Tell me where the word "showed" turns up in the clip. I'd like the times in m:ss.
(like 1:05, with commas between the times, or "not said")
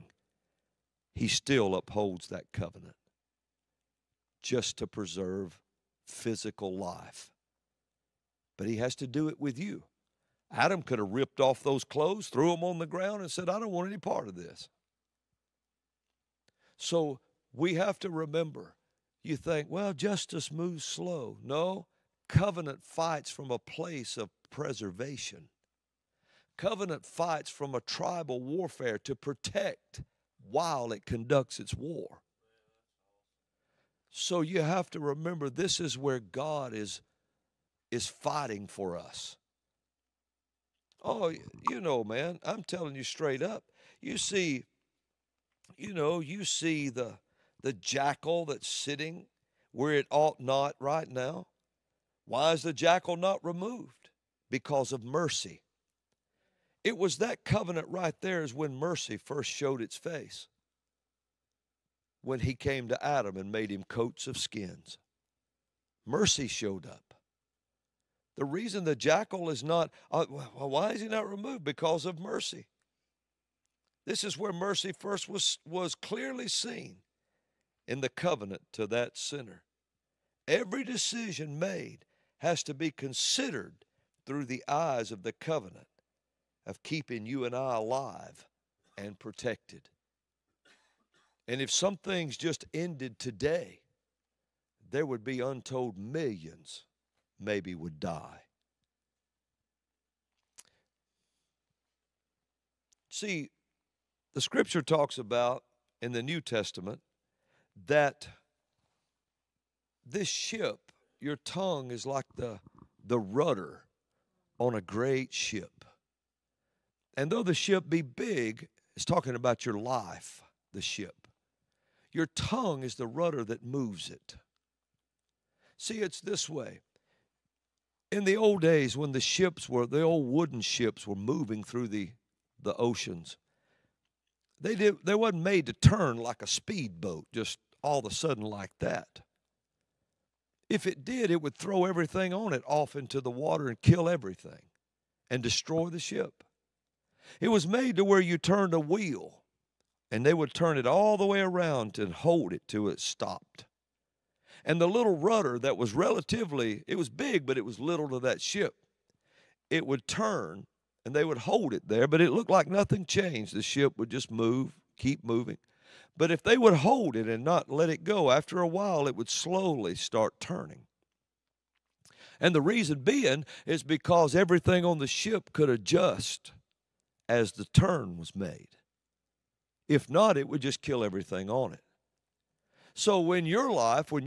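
0:59, 1:06.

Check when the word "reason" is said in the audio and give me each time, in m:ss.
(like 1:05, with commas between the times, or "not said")
1:08, 2:52.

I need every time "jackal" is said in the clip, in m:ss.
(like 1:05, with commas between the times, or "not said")
0:47, 0:52, 1:08.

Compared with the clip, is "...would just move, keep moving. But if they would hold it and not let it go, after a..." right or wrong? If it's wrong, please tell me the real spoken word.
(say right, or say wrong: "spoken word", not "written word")
right.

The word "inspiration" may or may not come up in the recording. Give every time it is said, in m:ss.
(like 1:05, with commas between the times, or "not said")
not said.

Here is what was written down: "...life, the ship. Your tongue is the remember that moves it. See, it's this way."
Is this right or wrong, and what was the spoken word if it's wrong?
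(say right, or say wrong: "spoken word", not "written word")
wrong: "rudder", not "remember".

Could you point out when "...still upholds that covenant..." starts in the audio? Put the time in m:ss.
0:01.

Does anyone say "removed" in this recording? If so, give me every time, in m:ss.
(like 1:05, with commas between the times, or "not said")
0:53, 1:11.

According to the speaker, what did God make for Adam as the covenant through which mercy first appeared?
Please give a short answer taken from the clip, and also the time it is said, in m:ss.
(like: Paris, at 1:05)
coats of skins, at 1:03.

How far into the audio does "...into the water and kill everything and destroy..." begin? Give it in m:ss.
2:22.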